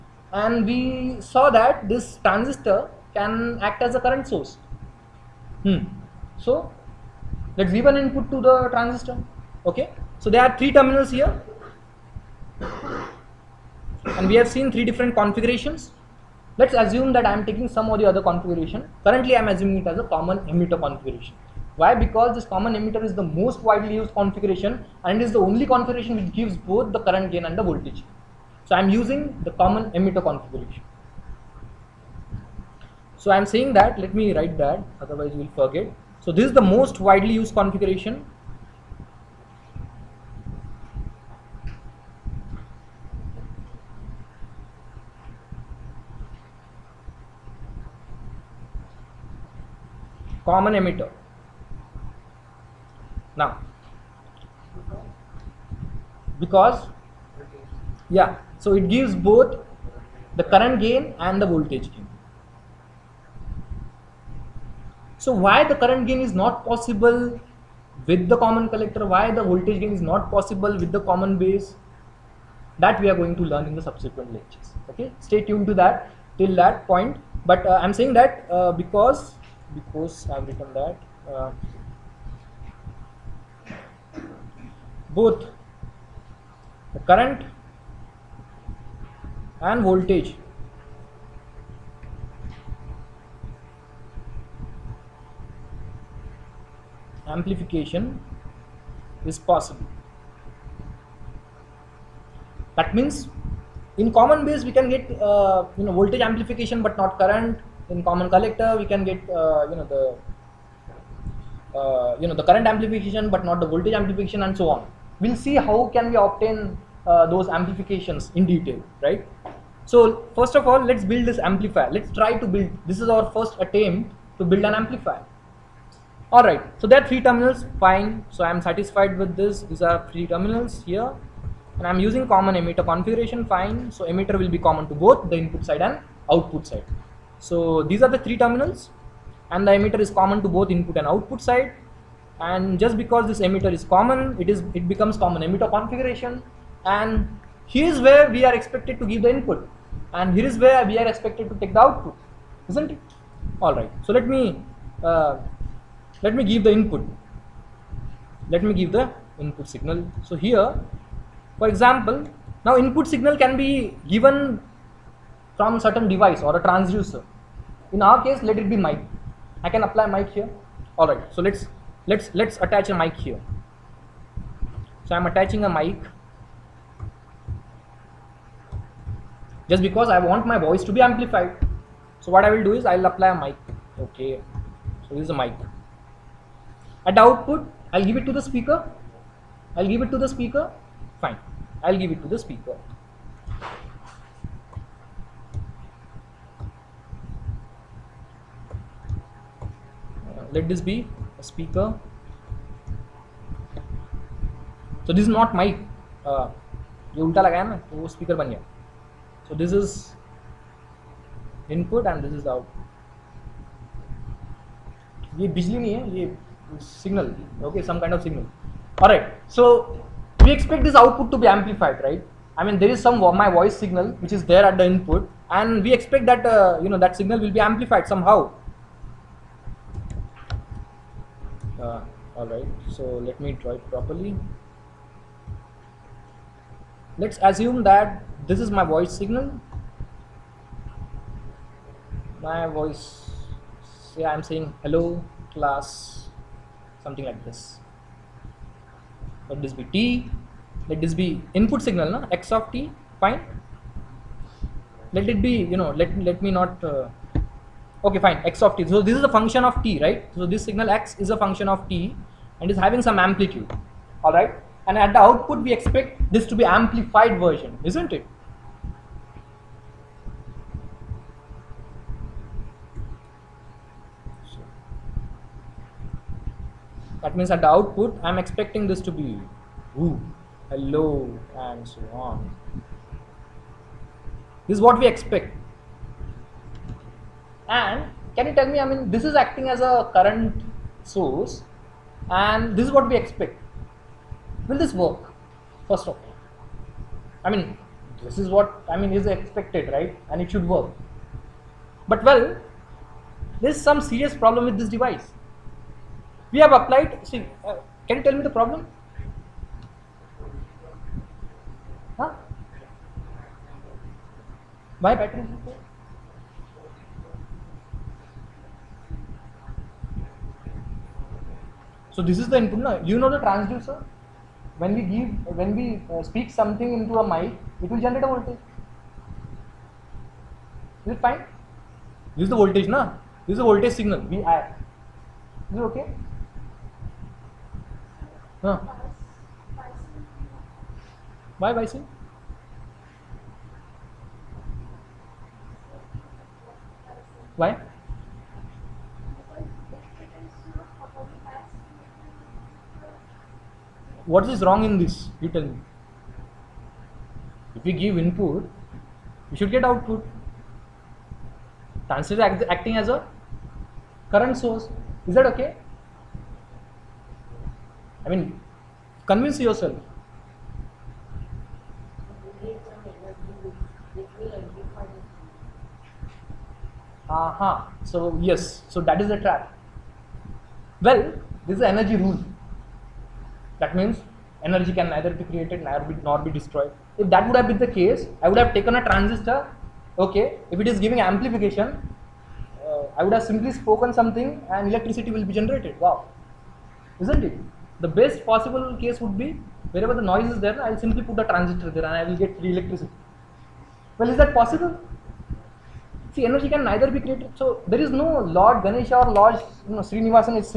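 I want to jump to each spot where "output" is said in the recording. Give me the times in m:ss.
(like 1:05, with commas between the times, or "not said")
2:16, 2:21, 2:31, 3:07, 3:40, 4:25, 4:37, 5:59.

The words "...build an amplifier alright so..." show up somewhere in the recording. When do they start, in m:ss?
2:04.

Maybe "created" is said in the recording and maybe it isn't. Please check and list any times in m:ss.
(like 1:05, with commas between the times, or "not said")
6:25, 6:47.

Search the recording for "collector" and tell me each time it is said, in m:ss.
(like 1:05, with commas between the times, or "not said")
1:08, 1:48.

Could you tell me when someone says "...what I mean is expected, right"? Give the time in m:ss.
4:58.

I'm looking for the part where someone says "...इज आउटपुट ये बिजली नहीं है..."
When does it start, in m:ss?
3:32.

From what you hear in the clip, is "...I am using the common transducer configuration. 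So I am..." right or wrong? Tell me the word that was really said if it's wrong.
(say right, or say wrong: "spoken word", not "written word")
wrong: "emitter", not "transducer".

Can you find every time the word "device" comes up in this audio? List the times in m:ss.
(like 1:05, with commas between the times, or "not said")
2:46, 5:04.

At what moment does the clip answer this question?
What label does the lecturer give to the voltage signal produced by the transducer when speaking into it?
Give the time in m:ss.
5:34.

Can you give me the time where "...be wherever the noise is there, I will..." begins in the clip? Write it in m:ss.
6:39.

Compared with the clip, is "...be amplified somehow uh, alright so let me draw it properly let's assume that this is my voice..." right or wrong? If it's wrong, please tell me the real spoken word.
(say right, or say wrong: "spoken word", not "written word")
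right.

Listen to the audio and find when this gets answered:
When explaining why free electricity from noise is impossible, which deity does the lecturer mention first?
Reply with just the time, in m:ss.
6:48.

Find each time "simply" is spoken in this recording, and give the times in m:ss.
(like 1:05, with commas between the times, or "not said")
6:33, 6:40.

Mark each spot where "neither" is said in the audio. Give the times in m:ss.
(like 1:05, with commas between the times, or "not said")
6:25, 6:46.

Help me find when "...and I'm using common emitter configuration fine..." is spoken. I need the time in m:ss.
2:11.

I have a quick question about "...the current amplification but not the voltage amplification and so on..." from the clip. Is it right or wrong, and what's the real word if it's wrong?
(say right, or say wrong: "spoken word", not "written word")
right.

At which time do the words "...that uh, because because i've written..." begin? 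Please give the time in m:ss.
1:18.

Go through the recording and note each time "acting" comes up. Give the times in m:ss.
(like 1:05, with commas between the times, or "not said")
4:49, 6:02.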